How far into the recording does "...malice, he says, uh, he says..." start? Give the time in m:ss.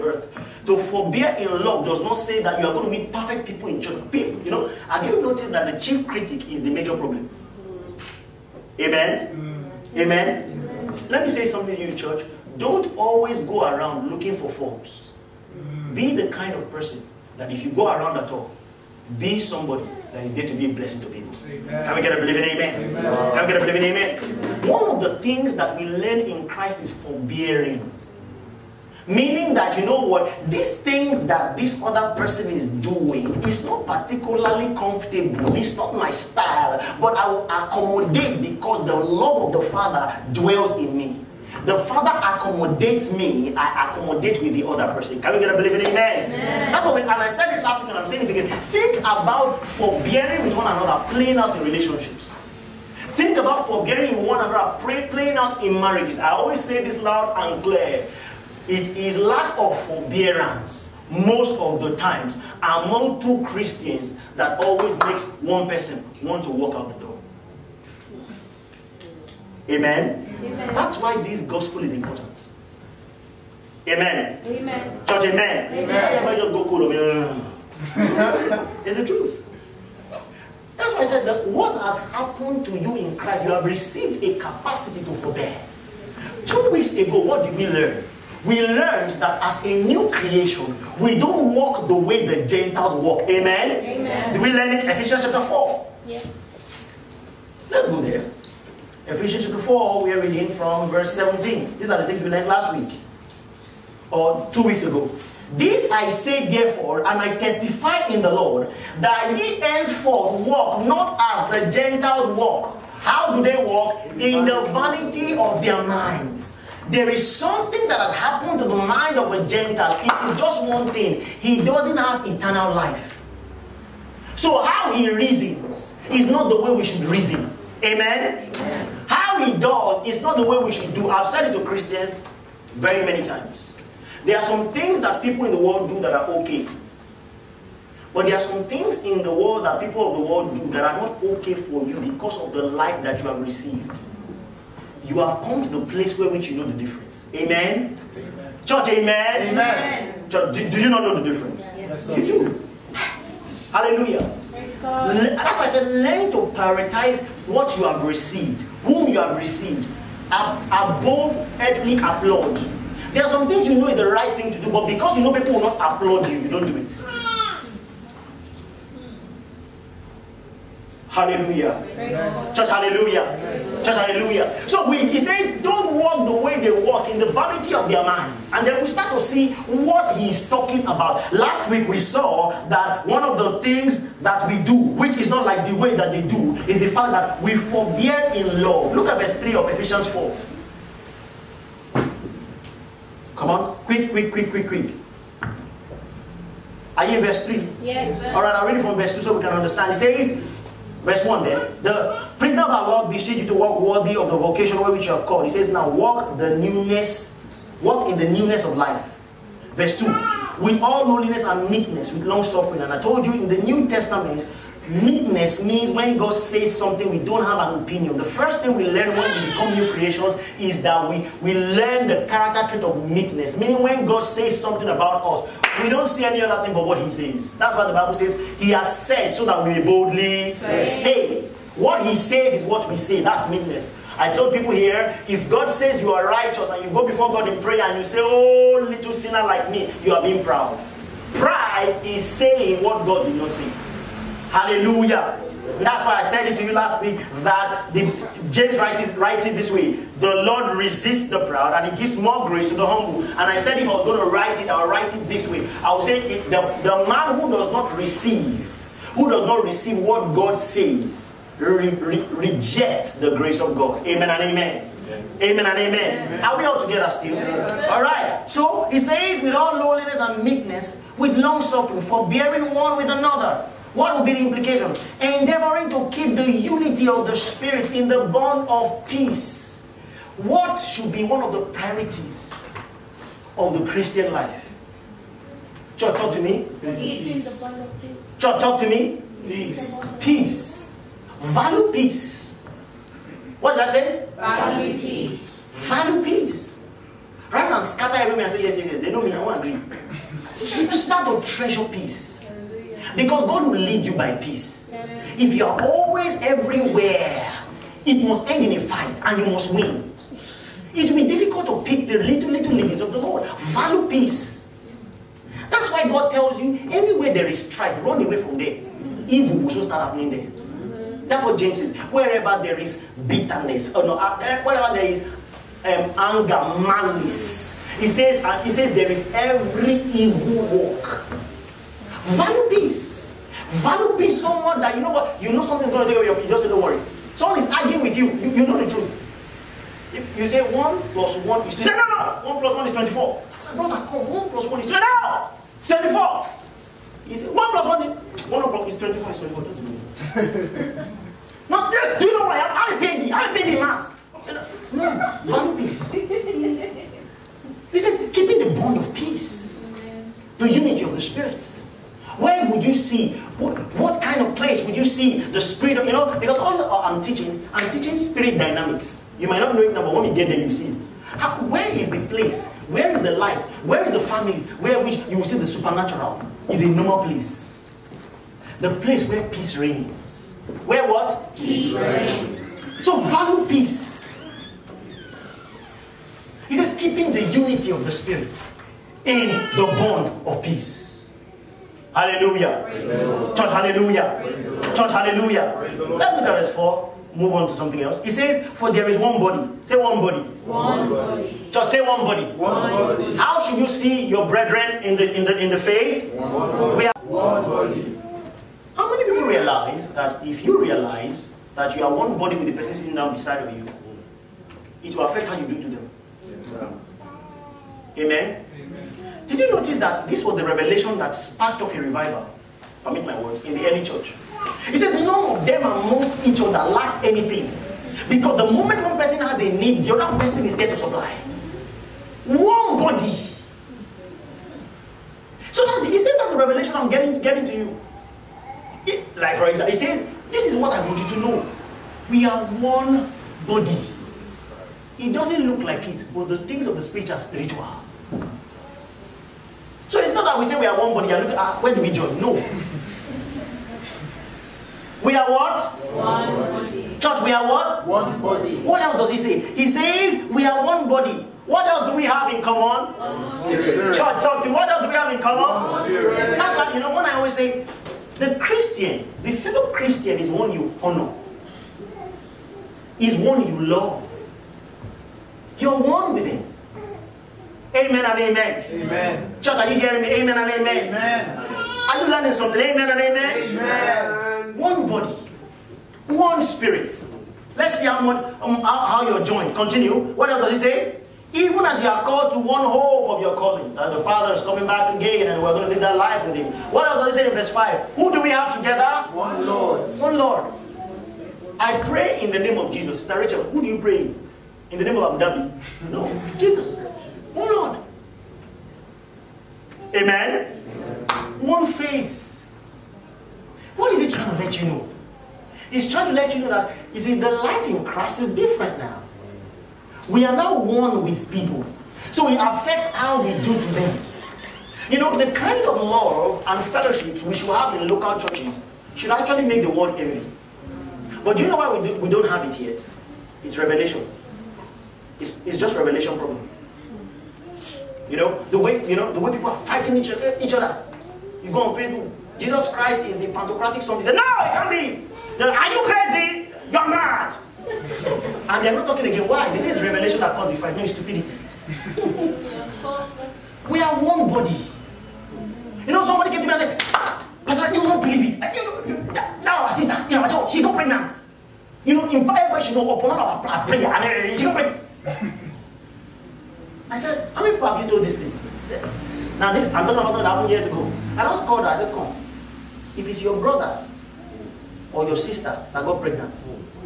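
5:26.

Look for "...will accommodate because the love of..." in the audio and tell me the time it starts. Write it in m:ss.
0:37.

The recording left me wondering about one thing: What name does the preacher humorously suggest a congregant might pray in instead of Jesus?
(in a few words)
Abu Dhabi.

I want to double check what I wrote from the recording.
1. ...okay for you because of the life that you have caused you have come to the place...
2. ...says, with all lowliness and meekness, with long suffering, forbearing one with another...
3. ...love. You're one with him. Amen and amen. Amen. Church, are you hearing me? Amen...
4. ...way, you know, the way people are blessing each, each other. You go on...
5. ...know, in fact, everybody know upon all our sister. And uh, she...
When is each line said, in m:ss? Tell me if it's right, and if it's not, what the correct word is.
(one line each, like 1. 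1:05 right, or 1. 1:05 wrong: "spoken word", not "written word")
1. 2:21 wrong: "received", not "caused"
2. 4:28 right
3. 7:53 right
4. 8:58 wrong: "fighting", not "blessing"
5. 9:22 wrong: "prayer", not "sister".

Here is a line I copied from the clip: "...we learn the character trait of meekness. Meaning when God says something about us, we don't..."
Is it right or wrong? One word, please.
right.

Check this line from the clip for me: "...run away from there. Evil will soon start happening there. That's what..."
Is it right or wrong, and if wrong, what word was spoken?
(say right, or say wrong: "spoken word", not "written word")
right.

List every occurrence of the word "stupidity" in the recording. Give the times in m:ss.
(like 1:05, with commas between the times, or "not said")
9:11.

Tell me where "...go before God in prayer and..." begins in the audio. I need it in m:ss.
3:56.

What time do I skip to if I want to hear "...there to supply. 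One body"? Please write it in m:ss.
7:10.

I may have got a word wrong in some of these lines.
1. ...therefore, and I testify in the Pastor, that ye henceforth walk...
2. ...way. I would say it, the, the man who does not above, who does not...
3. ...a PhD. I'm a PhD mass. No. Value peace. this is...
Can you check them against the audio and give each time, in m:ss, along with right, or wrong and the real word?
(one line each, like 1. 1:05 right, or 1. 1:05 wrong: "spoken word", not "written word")
1. 1:46 wrong: "Lord", not "Pastor"
2. 4:15 wrong: "receive", not "above"
3. 5:53 right.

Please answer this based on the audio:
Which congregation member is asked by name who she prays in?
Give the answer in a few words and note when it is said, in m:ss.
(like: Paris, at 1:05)
Rachel, at 8:23.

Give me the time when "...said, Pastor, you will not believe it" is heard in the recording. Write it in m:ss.
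9:16.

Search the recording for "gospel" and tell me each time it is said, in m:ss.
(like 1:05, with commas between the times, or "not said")
1:11.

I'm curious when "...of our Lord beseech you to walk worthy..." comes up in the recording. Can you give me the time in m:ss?
3:22.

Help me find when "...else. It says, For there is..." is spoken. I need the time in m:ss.
6:38.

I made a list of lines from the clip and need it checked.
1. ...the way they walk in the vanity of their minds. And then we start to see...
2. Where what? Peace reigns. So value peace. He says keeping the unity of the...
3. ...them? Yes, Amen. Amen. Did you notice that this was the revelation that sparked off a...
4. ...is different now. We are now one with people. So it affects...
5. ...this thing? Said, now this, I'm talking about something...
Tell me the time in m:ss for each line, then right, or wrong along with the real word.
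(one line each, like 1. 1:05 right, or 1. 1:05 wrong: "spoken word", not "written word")
1. 2:56 right
2. 6:20 right
3. 6:55 right
4. 8:38 right
5. 9:28 right.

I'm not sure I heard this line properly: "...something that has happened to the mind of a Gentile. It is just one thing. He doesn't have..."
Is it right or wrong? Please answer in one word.
right.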